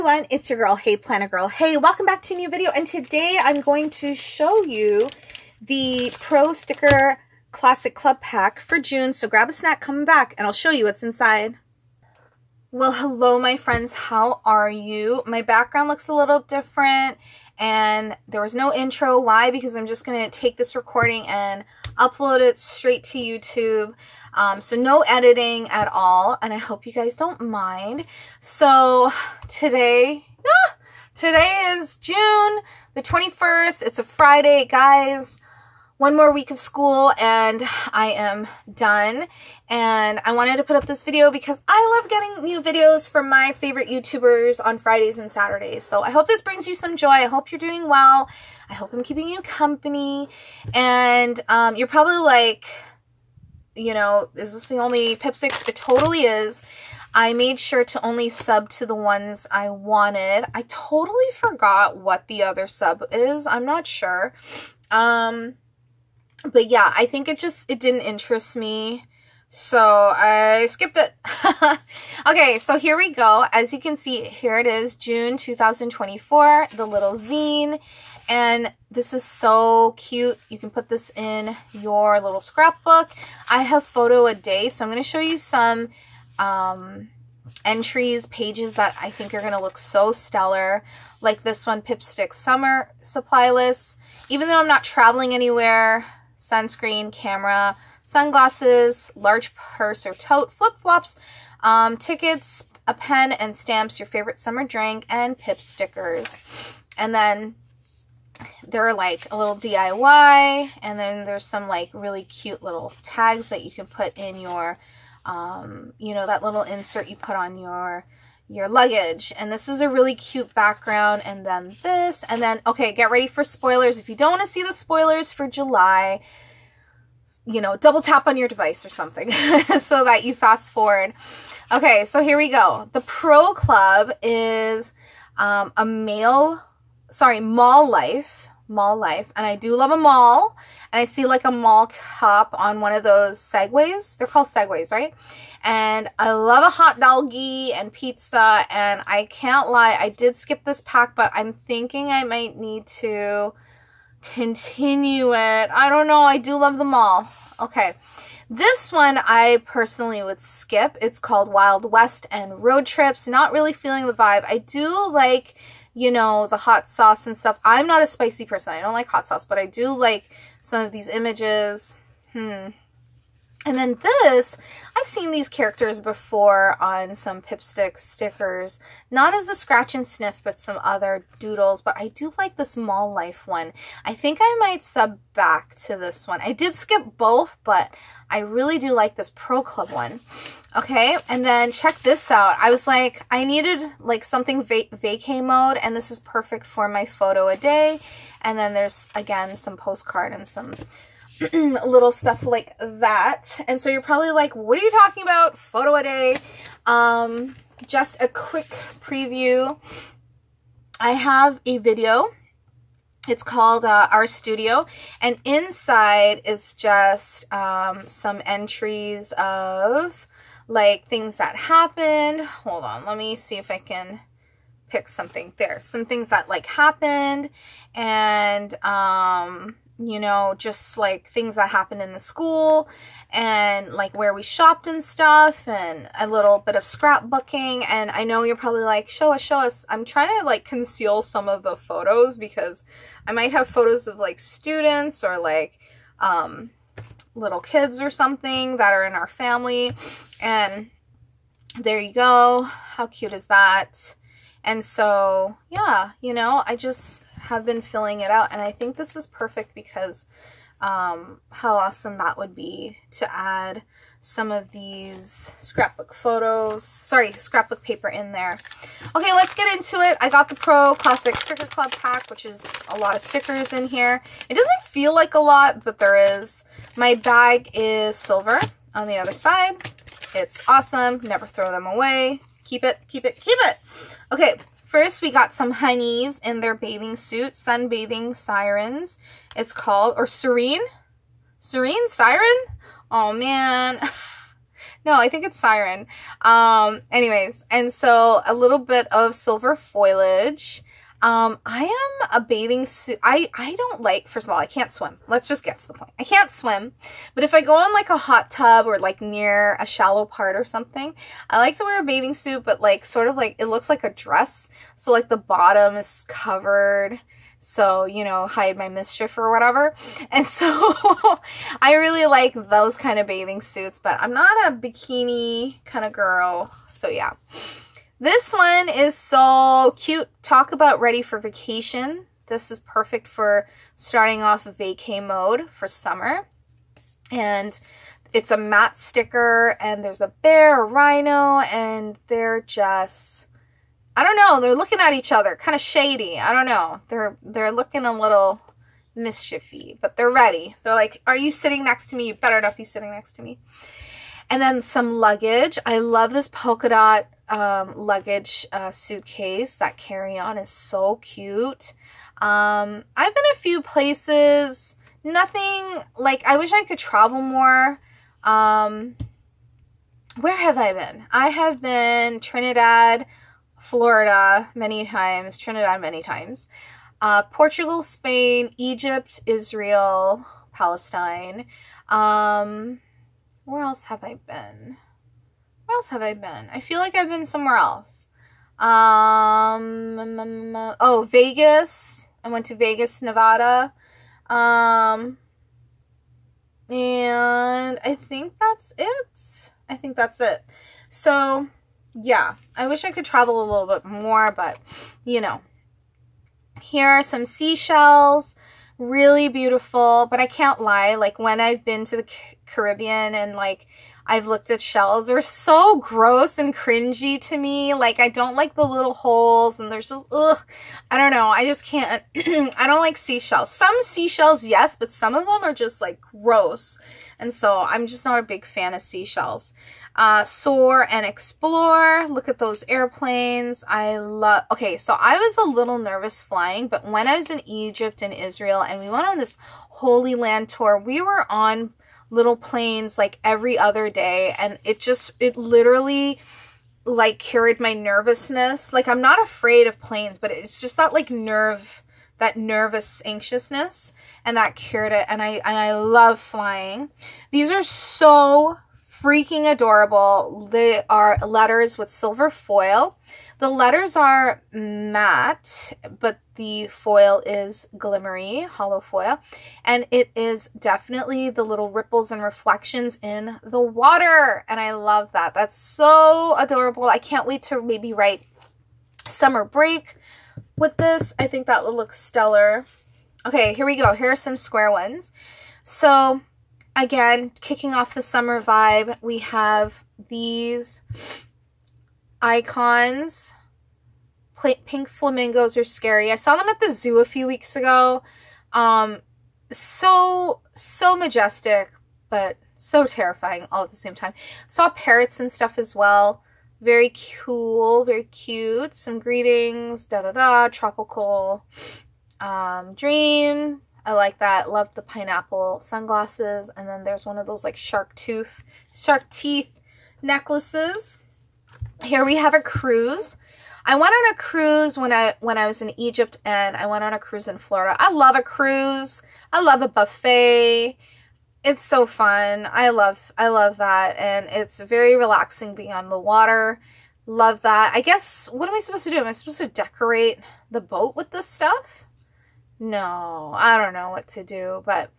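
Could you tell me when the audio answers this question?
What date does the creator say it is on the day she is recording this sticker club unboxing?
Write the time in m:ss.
0:31.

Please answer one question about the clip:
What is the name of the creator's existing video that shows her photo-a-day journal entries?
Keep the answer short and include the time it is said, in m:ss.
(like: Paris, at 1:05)
Our Studio, at 3:34.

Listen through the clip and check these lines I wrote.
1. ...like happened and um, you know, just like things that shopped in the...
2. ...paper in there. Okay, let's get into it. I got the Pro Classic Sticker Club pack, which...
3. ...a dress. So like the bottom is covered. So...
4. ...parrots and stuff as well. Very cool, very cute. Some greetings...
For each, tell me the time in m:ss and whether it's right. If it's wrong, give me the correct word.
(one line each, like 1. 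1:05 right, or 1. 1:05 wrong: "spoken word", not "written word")
1. 3:46 wrong: "happened", not "shopped"
2. 4:27 right
3. 5:14 right
4. 8:24 right.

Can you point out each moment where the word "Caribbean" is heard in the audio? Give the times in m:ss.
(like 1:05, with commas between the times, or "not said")
6:52.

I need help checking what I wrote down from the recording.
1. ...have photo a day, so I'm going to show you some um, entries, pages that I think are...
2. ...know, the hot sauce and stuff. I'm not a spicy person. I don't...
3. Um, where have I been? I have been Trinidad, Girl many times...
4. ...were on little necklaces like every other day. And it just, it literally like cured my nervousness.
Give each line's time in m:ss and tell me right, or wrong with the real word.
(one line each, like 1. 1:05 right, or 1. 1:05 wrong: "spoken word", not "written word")
1. 1:23 right
2. 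2:46 right
3. 6:08 wrong: "Florida", not "Girl"
4. 7:21 wrong: "planes", not "necklaces".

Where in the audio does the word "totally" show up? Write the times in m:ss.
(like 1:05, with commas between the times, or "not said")
0:55, 1:00.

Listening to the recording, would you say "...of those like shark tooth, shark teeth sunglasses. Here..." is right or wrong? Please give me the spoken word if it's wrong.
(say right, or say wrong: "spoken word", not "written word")
wrong: "necklaces", not "sunglasses".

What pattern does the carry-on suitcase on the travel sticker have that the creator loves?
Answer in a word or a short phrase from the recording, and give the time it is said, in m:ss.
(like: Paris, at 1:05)
Polka dot, at 5:56.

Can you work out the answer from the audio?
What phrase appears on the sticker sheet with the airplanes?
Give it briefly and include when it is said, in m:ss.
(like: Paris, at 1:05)
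Soar and explore, at 7:10.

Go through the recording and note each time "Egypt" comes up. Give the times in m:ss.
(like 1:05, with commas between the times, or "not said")
6:18, 7:17, 8:45.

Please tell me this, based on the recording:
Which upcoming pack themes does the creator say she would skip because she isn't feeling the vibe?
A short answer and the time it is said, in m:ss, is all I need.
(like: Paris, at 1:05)
Wild West and Road Trips, at 2:41.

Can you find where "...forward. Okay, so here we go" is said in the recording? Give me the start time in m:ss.
2:10.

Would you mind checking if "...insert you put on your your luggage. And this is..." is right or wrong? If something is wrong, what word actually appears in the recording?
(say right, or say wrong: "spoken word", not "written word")
right.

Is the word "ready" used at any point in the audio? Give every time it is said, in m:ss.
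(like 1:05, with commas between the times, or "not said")
2:03, 5:31, 5:50.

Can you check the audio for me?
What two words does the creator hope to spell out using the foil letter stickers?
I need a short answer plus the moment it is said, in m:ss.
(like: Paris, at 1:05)
Summer break, at 7:59.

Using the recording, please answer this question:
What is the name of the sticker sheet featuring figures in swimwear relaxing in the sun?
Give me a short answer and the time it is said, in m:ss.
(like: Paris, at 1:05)
Sunbathing Sirens, at 4:47.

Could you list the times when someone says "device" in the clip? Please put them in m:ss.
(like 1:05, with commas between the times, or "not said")
2:08.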